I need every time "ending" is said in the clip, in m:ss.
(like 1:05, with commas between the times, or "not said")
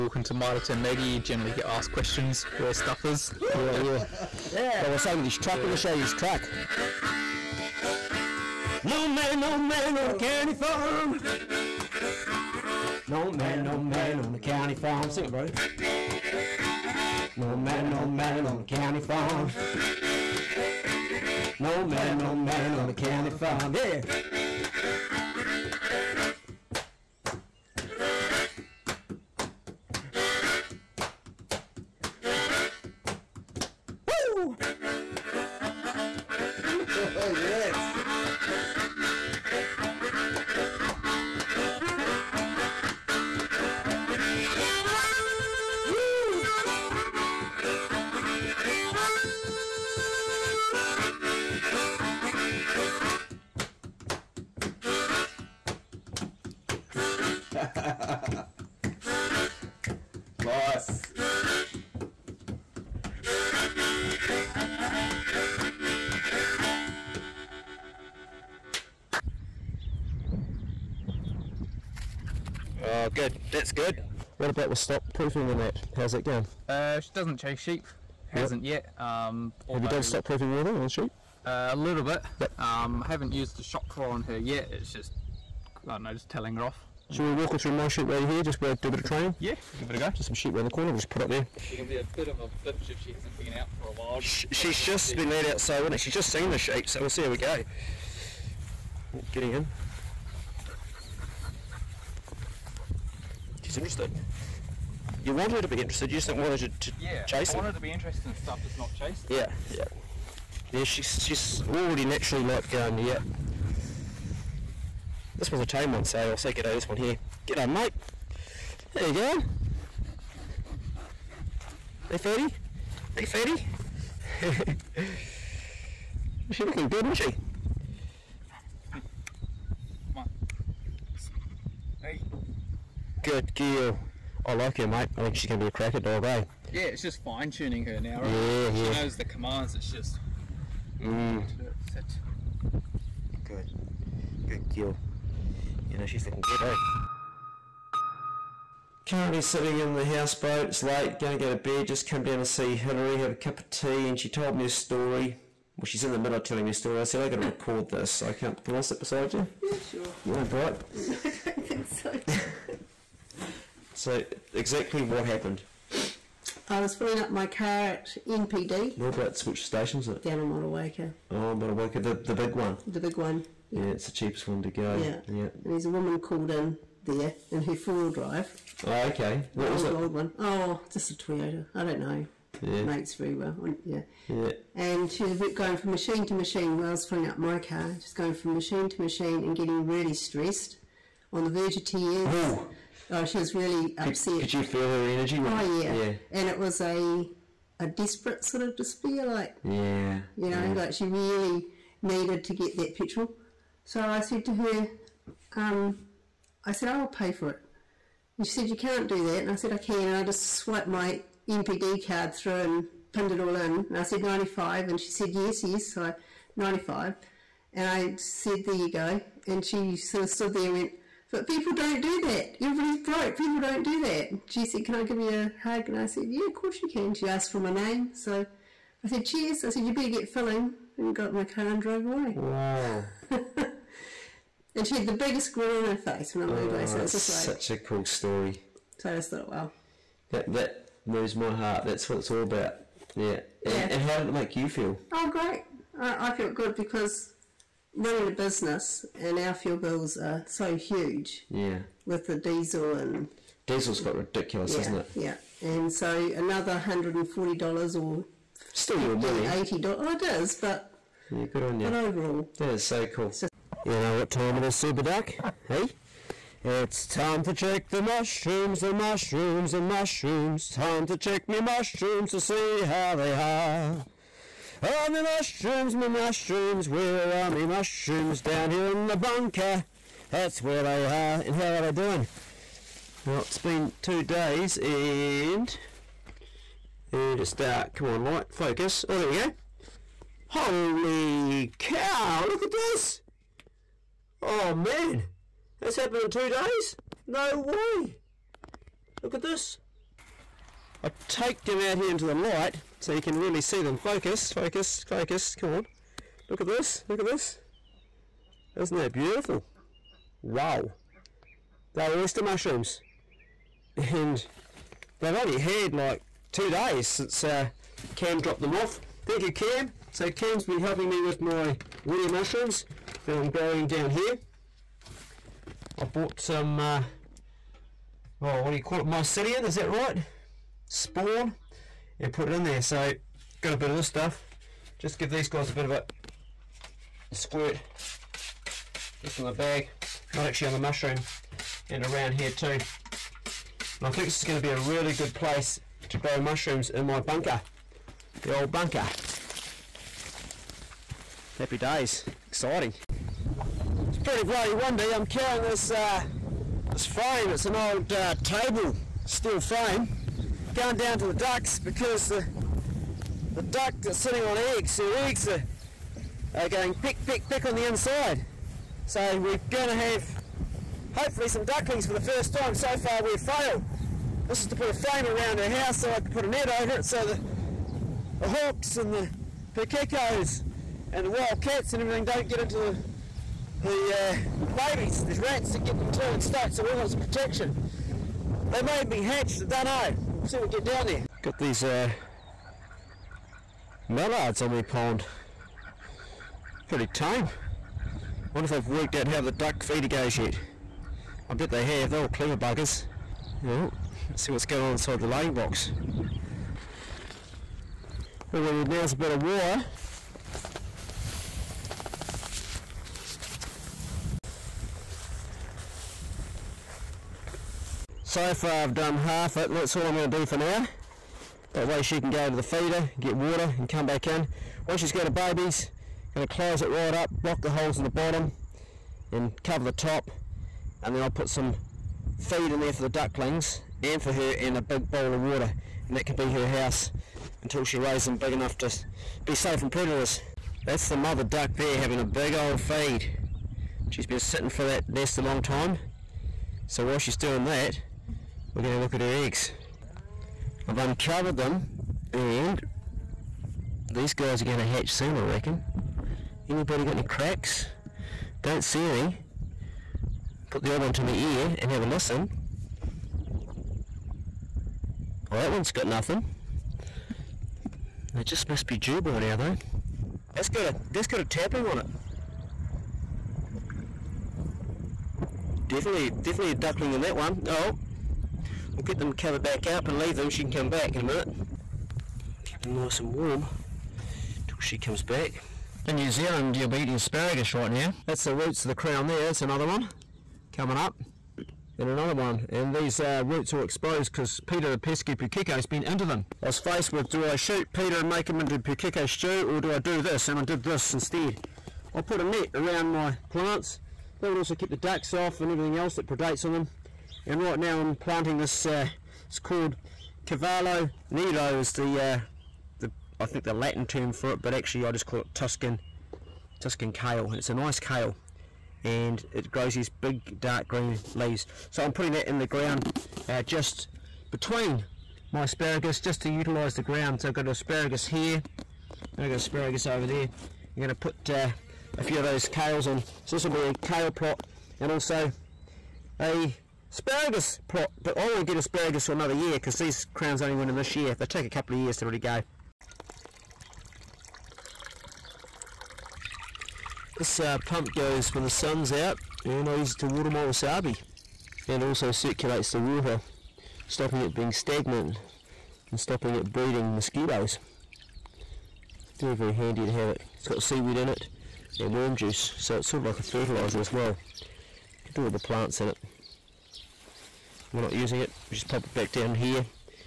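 not said.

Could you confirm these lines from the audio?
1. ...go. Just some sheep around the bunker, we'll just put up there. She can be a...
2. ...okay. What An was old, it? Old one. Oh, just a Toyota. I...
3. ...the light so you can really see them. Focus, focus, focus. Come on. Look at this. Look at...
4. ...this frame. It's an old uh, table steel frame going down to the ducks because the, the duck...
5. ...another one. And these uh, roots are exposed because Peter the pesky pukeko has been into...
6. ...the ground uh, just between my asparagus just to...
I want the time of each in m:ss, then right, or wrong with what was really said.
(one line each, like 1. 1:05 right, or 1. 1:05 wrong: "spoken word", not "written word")
1. 1:29 wrong: "corner", not "bunker"
2. 2:59 right
3. 5:02 right
4. 5:56 right
5. 8:12 right
6. 8:42 right.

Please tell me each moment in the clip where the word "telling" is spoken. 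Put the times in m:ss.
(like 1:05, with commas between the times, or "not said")
1:26, 2:36.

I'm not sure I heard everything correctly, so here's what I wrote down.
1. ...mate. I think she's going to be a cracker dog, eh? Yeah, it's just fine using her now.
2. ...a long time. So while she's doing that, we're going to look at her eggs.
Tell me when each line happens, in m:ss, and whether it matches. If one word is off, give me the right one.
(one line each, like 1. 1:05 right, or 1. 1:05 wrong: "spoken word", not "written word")
1. 2:14 wrong: "tuning", not "using"
2. 7:25 right.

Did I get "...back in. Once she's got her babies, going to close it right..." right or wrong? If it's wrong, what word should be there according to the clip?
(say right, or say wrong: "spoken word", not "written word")
right.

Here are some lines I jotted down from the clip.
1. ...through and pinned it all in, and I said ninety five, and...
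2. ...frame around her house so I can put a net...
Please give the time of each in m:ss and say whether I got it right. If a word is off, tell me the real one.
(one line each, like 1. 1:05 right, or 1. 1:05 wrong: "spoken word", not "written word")
1. 3:32 right
2. 6:14 right.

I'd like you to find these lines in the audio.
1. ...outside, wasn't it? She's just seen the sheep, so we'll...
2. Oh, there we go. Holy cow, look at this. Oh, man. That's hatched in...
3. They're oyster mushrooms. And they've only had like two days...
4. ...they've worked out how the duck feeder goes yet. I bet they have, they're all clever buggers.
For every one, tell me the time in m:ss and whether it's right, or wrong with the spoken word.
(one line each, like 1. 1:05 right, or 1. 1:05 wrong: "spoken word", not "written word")
1. 1:35 right
2. 4:49 wrong: "happened", not "hatched"
3. 5:11 right
4. 6:38 right.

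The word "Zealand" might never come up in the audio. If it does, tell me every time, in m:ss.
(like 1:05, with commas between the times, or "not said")
8:06.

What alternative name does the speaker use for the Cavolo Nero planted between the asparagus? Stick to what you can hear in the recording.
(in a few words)
Tuscan kale.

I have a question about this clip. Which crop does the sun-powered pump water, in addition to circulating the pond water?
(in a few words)
Wasabi.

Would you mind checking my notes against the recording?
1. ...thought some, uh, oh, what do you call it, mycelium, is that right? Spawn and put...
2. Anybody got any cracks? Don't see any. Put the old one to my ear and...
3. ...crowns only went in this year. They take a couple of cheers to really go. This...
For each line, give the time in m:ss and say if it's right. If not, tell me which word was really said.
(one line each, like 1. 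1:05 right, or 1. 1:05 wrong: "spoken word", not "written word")
1. 5:26 wrong: "bought", not "thought"
2. 7:36 right
3. 9:00 wrong: "years", not "cheers".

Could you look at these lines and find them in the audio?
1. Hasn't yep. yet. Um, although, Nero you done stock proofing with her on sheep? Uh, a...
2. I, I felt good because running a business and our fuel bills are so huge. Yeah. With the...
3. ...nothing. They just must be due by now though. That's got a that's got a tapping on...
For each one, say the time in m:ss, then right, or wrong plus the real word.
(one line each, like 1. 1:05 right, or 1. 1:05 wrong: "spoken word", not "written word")
1. 1:18 wrong: "Have", not "Nero"
2. 4:05 right
3. 7:46 right.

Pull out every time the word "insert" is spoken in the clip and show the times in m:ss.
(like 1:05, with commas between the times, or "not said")
not said.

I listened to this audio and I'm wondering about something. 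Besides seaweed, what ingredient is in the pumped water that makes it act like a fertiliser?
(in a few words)
Worm juice.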